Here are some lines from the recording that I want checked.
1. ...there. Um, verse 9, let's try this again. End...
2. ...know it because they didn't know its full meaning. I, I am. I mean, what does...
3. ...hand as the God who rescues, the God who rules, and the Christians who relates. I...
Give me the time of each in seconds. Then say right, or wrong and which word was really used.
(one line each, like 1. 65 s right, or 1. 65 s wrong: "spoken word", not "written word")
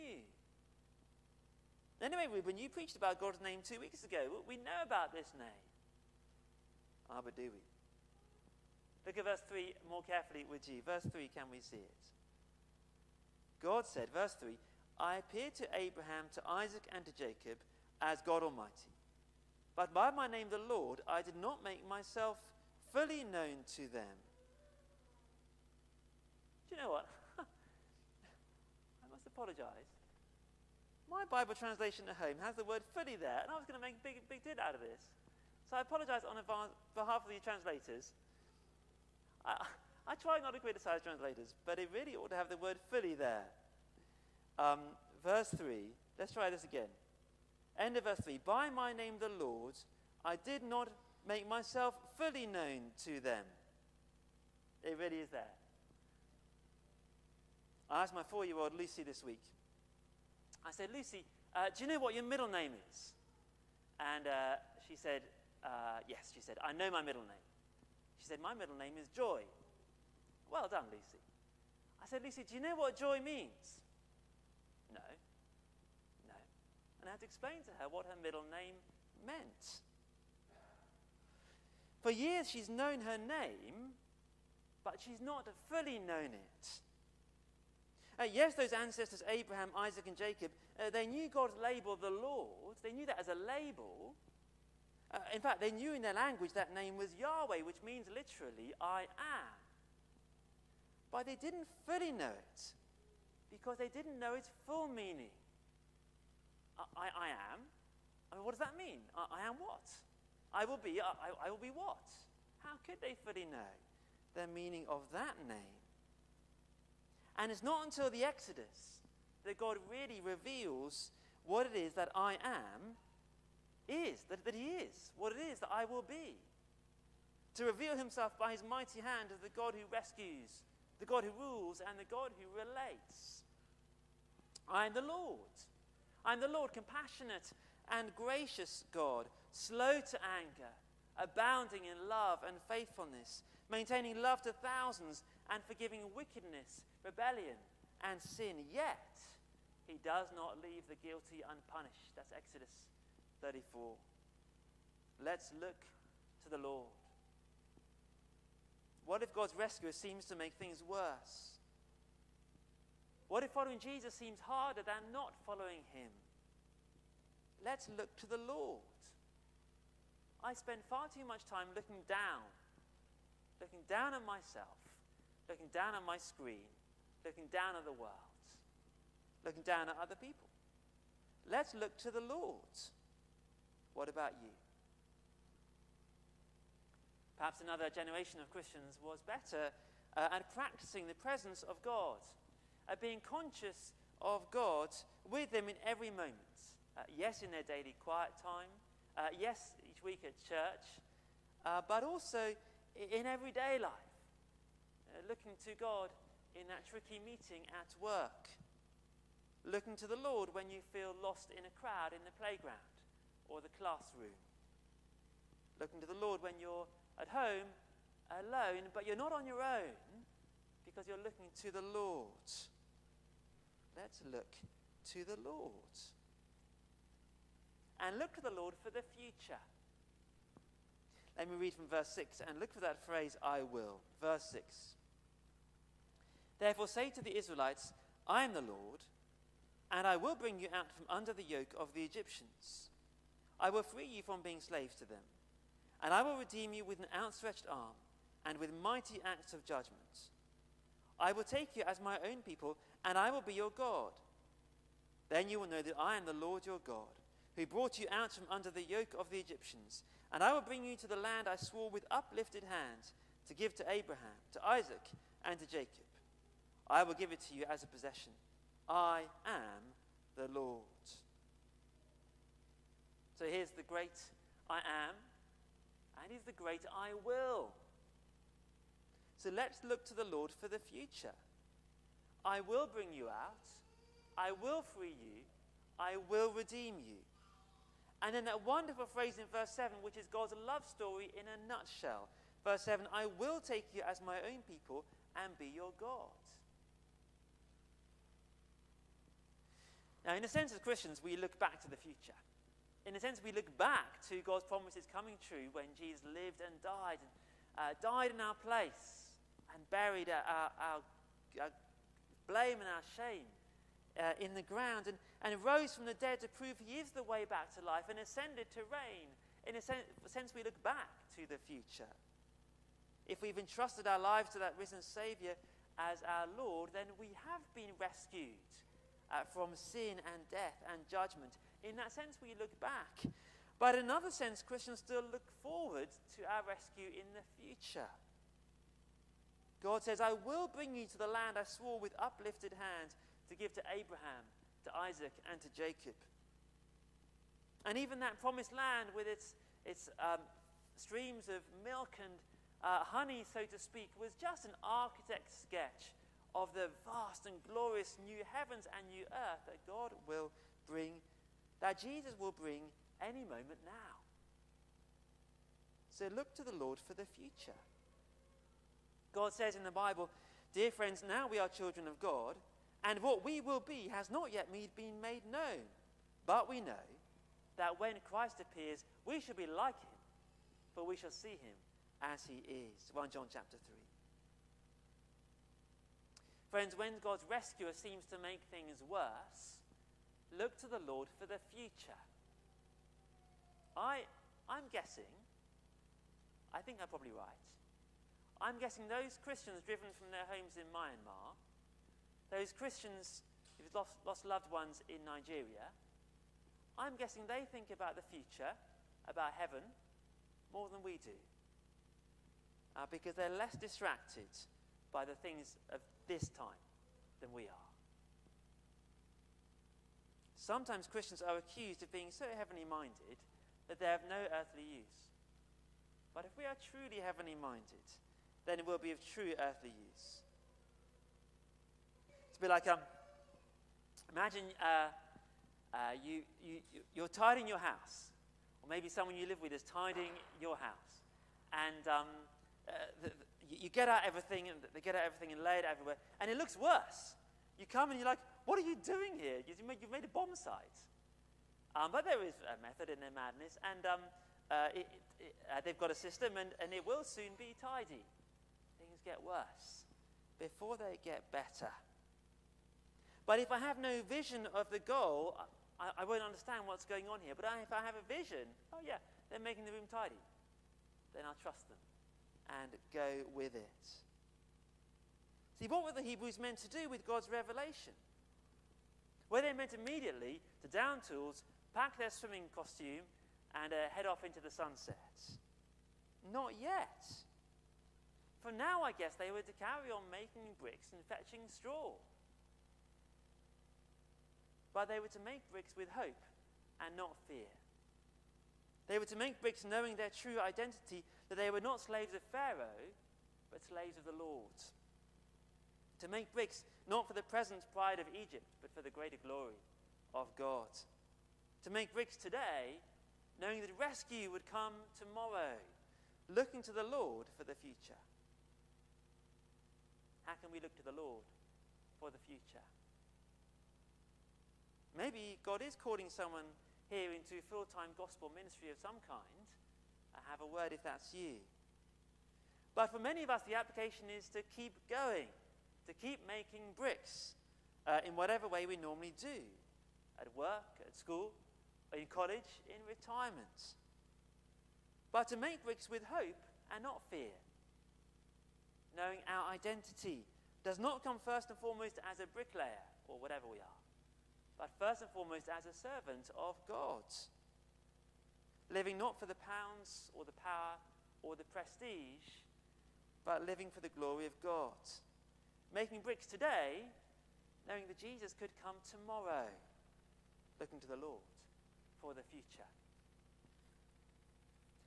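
1. 43 s wrong: "3", not "9"
2. 102 s right
3. 128 s wrong: "God", not "Christians".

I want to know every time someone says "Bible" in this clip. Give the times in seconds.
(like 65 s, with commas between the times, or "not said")
31 s, 369 s.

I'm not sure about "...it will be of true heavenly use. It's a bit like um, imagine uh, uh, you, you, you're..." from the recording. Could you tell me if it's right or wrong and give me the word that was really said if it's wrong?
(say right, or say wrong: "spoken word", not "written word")
wrong: "earthly", not "heavenly".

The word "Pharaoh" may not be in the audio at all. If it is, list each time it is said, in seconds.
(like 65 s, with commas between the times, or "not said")
502 s.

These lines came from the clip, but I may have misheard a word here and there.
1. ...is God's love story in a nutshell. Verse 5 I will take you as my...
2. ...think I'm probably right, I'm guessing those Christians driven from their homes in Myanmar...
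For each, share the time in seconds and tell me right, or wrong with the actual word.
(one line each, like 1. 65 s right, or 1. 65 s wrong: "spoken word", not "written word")
1. 290 s wrong: "7", not "5"
2. 396 s right.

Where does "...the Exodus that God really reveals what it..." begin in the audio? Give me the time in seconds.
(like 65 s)
118 s.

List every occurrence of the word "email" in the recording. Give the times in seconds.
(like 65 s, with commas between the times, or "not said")
not said.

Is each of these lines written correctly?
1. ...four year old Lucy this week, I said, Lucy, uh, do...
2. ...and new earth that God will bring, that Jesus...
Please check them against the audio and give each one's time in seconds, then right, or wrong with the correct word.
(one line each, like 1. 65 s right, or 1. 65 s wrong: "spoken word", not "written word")
1. 58 s right
2. 358 s right.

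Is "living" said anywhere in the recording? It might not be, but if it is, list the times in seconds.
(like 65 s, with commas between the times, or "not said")
558 s, 563 s.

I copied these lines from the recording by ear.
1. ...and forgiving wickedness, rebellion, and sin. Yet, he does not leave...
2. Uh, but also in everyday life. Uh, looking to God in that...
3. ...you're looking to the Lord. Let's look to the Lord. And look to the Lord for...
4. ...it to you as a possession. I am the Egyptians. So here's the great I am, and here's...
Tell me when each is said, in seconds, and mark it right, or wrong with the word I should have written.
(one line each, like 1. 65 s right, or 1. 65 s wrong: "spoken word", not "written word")
1. 145 s right
2. 201 s right
3. 221 s right
4. 267 s wrong: "Lord", not "Egyptians".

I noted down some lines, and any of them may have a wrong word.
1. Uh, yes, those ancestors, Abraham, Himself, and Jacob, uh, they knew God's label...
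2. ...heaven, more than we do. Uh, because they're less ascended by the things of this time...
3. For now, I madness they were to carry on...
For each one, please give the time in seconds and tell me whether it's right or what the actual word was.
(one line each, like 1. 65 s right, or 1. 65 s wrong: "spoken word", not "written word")
1. 88 s wrong: "Isaac", not "Himself"
2. 409 s wrong: "distracted", not "ascended"
3. 488 s wrong: "guess", not "madness".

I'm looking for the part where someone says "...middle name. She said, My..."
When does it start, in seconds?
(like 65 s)
67 s.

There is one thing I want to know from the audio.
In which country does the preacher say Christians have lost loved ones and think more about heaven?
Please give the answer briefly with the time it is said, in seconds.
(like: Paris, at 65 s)
Nigeria, at 405 s.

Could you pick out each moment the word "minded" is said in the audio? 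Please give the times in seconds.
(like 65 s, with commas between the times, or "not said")
422 s, 427 s.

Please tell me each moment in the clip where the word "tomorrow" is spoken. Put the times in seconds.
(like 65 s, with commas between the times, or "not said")
515 s, 569 s.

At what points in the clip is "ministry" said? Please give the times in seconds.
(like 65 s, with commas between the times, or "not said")
528 s.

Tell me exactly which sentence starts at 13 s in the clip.
God said, verse 3, I appeared to Abraham, to Isaac, and to Jacob as God Almighty.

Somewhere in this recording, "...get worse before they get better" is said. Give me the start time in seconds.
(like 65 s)
459 s.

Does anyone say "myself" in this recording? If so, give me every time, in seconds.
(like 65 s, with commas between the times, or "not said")
21 s, 51 s, 174 s.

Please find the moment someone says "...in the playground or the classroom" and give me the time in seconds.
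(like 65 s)
212 s.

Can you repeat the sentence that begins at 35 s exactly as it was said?
So I apologize on behalf of the translators.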